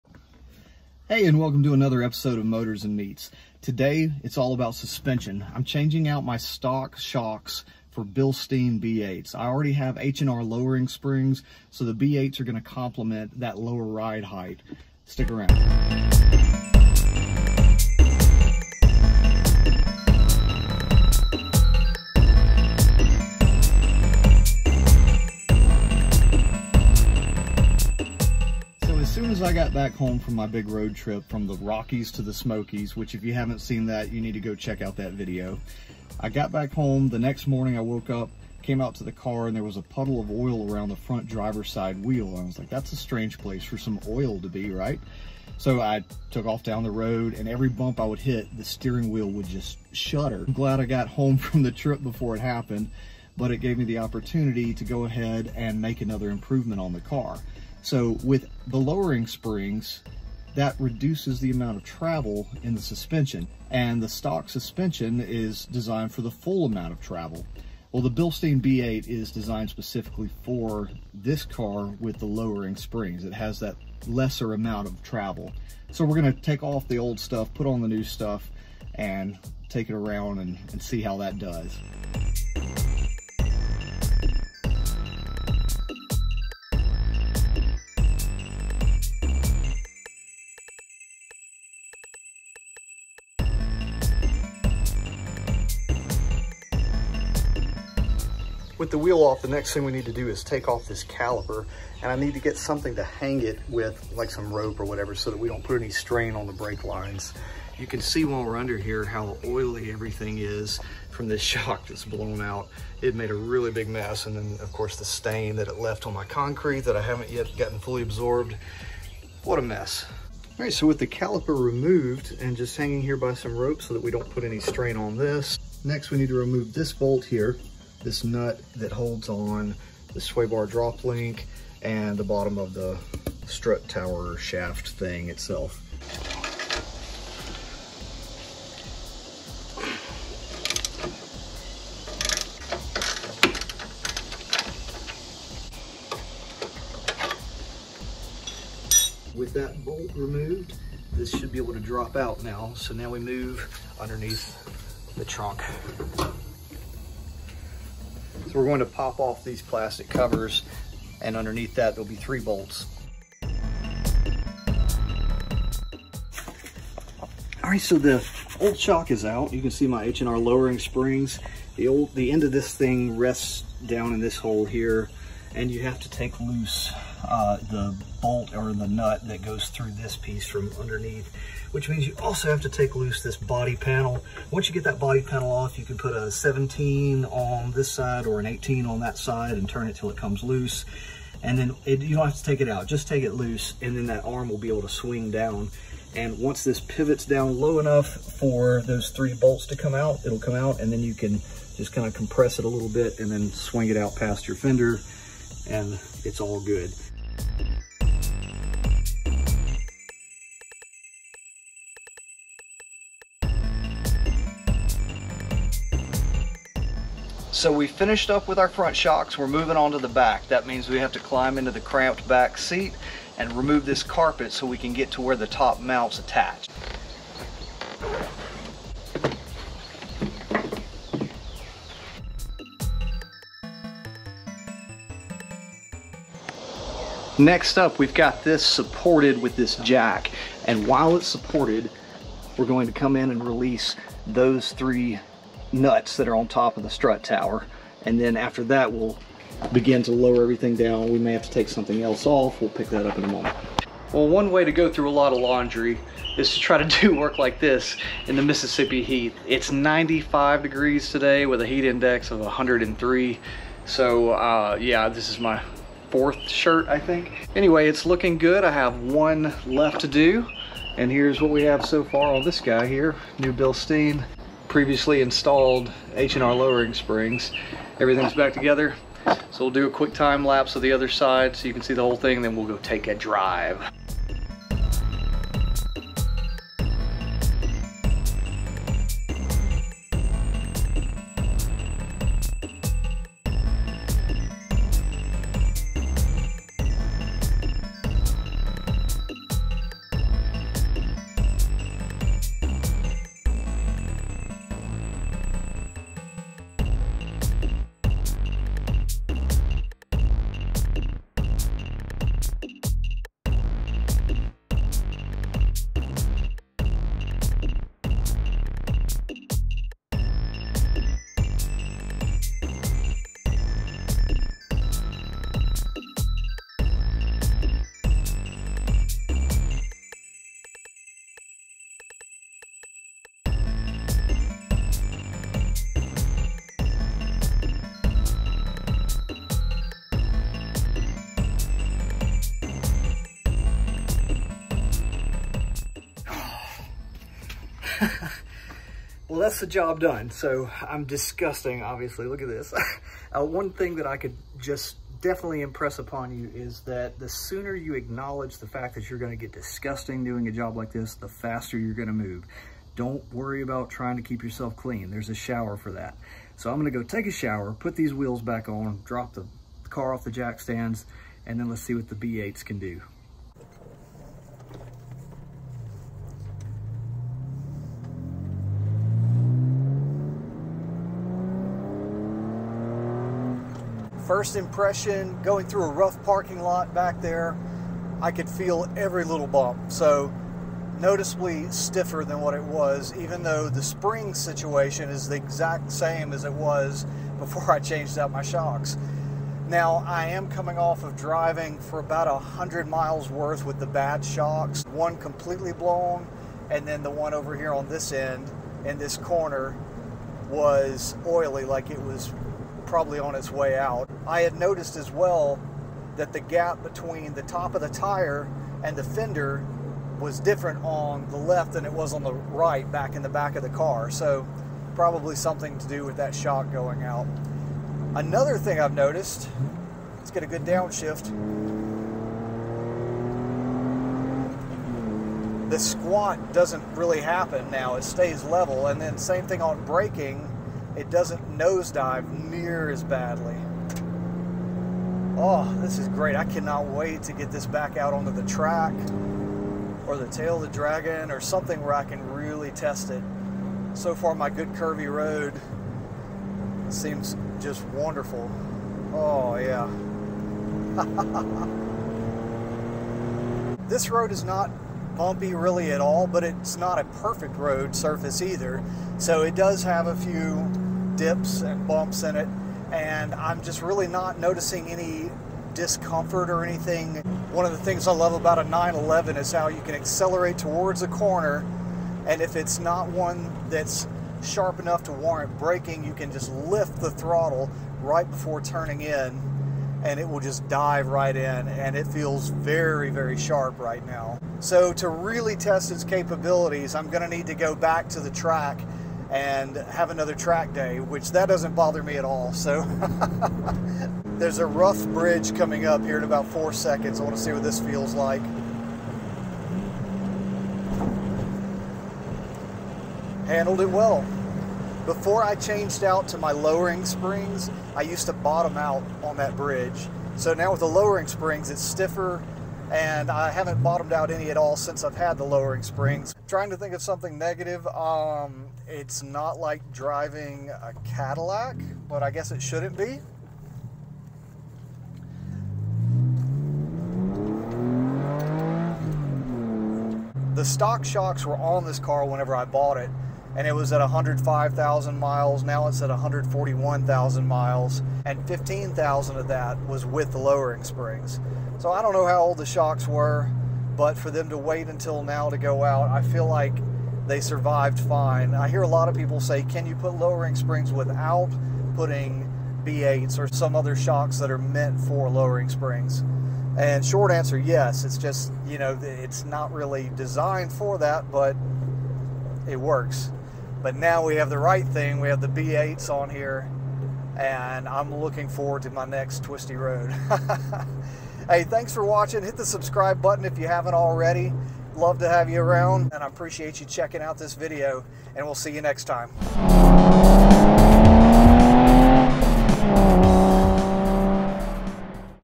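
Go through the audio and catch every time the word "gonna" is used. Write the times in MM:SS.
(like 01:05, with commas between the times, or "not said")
00:12, 01:16.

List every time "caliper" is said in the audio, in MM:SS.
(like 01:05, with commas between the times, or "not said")
01:41, 02:01.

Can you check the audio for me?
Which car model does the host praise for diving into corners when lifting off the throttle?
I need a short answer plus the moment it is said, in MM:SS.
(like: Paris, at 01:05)
911, at 07:58.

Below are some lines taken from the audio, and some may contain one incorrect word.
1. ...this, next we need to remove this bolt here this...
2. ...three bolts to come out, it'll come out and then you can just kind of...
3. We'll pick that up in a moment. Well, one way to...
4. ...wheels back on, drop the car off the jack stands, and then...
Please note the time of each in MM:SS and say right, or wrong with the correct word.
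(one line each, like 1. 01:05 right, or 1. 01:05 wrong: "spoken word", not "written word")
1. 02:05 right
2. 03:19 right
3. 04:12 right
4. 06:08 right.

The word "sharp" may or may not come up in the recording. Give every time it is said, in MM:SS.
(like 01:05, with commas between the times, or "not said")
08:04, 08:13.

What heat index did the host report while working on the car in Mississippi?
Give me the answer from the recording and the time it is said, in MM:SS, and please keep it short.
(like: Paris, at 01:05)
103, at 04:22.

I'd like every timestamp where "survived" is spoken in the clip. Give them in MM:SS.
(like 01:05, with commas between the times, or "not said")
09:17.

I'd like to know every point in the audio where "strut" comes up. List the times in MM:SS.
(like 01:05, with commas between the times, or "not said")
02:13, 04:06.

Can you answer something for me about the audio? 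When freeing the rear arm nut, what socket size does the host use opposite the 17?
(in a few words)
18.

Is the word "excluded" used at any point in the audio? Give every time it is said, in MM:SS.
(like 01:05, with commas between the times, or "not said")
not said.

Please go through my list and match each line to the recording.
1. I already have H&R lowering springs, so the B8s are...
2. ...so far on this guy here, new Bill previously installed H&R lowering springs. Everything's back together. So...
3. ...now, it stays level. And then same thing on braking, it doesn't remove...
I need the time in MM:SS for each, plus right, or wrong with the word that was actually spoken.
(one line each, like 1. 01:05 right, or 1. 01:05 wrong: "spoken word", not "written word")
1. 00:09 right
2. 04:31 right
3. 07:17 wrong: "nosedive", not "remove".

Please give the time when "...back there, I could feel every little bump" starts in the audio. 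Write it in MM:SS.
06:26.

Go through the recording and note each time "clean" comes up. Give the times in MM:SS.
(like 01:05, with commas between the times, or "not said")
06:04.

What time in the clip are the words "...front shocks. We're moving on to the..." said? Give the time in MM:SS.
03:38.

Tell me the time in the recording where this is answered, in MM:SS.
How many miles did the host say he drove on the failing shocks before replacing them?
06:42.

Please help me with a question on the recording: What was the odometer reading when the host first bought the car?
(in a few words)
105,000 miles.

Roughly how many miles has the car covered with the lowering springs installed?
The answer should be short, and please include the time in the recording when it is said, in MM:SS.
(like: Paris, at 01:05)
15,000, at 09:08.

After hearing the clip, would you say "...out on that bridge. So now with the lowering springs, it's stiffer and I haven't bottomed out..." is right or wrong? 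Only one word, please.
right.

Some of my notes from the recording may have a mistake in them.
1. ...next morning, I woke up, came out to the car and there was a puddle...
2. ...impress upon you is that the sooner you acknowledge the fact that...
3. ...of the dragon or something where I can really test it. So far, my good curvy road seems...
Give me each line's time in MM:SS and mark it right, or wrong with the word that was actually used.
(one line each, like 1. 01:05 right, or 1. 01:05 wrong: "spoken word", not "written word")
1. 00:37 right
2. 05:55 right
3. 07:30 right.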